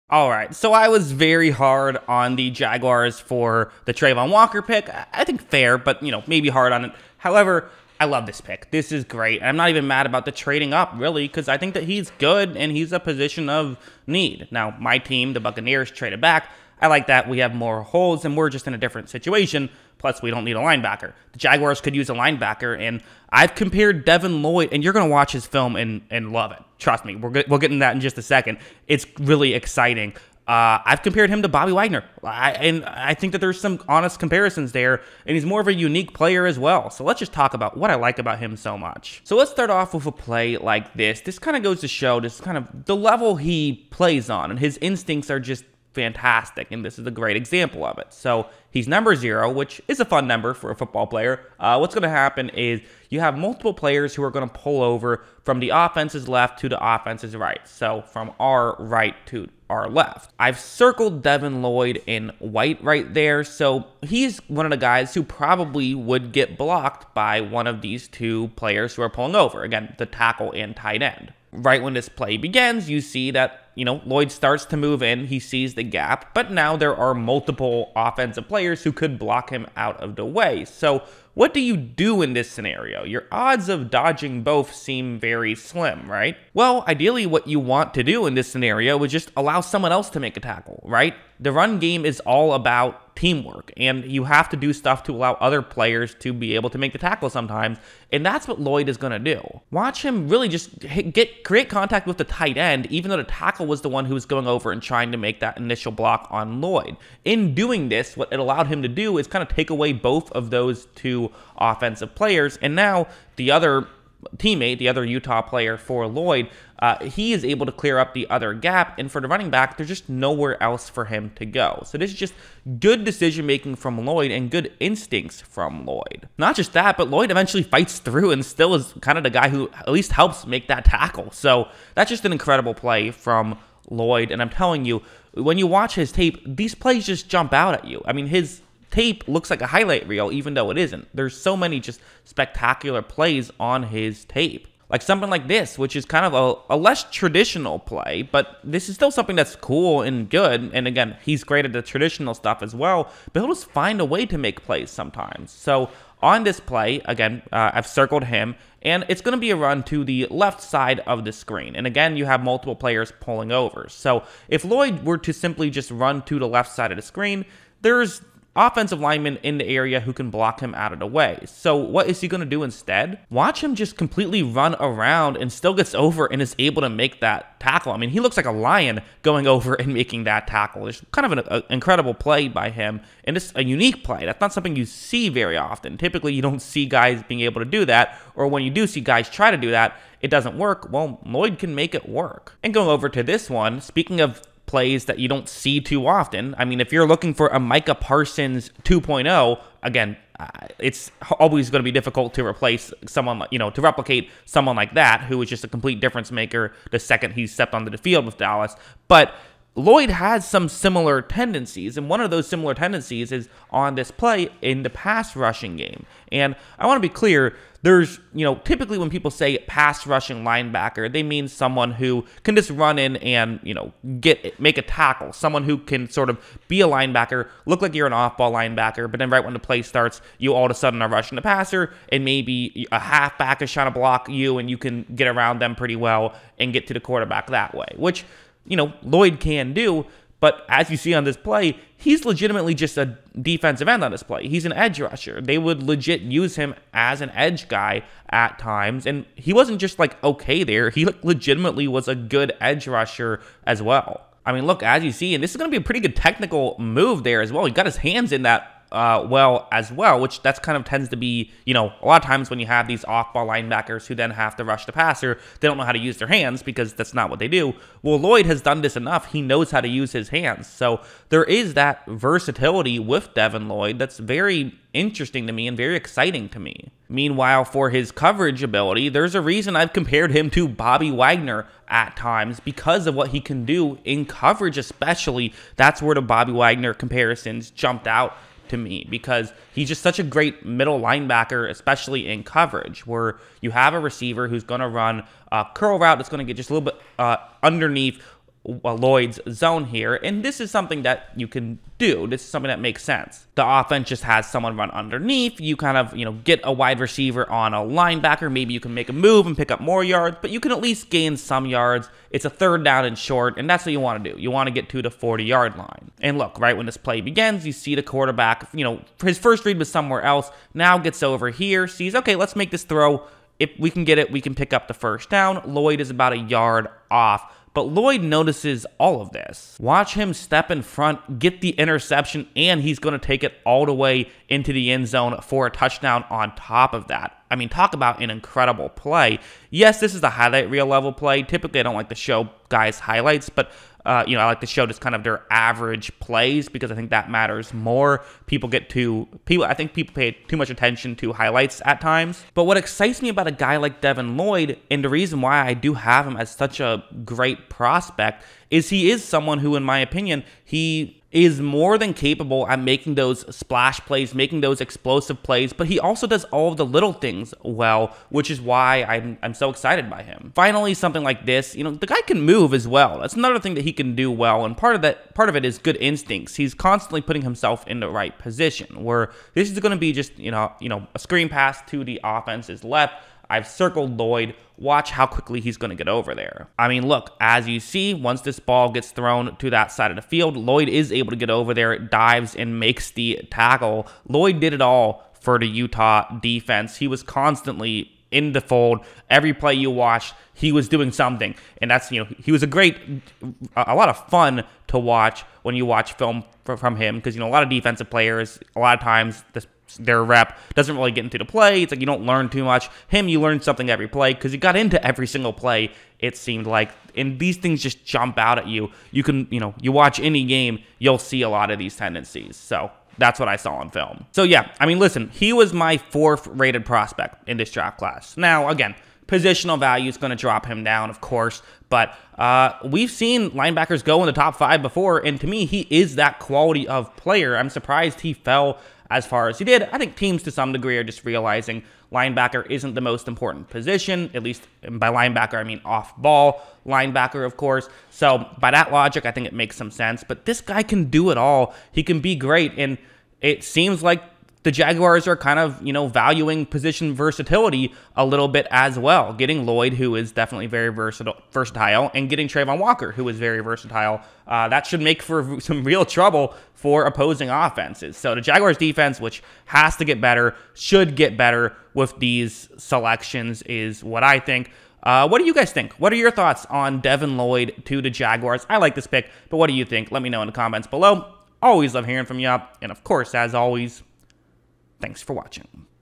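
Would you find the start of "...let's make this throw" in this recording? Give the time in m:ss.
5:22.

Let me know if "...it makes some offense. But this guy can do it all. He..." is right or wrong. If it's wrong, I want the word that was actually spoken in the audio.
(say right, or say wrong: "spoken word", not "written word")
wrong: "sense", not "offense".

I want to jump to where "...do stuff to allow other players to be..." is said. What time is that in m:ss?
1:34.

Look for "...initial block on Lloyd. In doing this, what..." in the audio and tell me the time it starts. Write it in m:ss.
1:45.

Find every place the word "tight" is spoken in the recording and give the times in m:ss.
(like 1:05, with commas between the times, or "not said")
1:10, 1:42.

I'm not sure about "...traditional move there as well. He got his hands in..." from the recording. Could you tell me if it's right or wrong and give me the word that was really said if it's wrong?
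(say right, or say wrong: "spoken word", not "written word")
wrong: "technical", not "traditional".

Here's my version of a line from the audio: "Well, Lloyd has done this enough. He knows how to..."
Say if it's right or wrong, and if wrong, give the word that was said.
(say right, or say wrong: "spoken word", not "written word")
right.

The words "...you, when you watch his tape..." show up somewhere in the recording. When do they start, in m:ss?
2:14.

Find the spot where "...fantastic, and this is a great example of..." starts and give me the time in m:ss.
0:45.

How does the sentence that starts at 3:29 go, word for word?
But Lloyd has some similar tendencies, and one of those similar tendencies is on display in the pass rushing game.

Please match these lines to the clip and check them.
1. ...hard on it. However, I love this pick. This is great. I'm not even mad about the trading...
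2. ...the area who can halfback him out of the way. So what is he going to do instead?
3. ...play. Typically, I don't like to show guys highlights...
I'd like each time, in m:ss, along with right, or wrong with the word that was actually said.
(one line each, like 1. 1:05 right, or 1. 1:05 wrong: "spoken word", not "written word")
1. 0:06 right
2. 2:49 wrong: "block", not "halfback"
3. 5:41 right.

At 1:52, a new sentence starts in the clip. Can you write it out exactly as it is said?
And now the other teammate, the other Utah player for Lloyd, uh, he is able to clear up the other gap.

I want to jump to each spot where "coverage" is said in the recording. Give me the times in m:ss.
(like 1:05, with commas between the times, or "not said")
4:38, 4:44, 4:52.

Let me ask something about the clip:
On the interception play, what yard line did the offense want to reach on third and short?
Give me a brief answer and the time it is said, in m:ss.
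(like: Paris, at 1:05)
40, at 5:15.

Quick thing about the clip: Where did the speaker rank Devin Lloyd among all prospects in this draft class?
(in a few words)
4th.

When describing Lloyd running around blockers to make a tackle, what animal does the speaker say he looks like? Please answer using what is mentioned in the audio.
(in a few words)
Lion.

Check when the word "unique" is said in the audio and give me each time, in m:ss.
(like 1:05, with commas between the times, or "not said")
0:35, 3:03.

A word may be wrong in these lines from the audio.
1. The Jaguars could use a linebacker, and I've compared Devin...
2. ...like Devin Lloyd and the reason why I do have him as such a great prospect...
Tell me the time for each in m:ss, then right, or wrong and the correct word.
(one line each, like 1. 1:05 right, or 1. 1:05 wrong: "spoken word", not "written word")
1. 0:21 right
2. 5:53 right.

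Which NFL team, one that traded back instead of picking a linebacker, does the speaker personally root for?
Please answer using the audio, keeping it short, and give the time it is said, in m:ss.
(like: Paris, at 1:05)
Buccaneers, at 0:15.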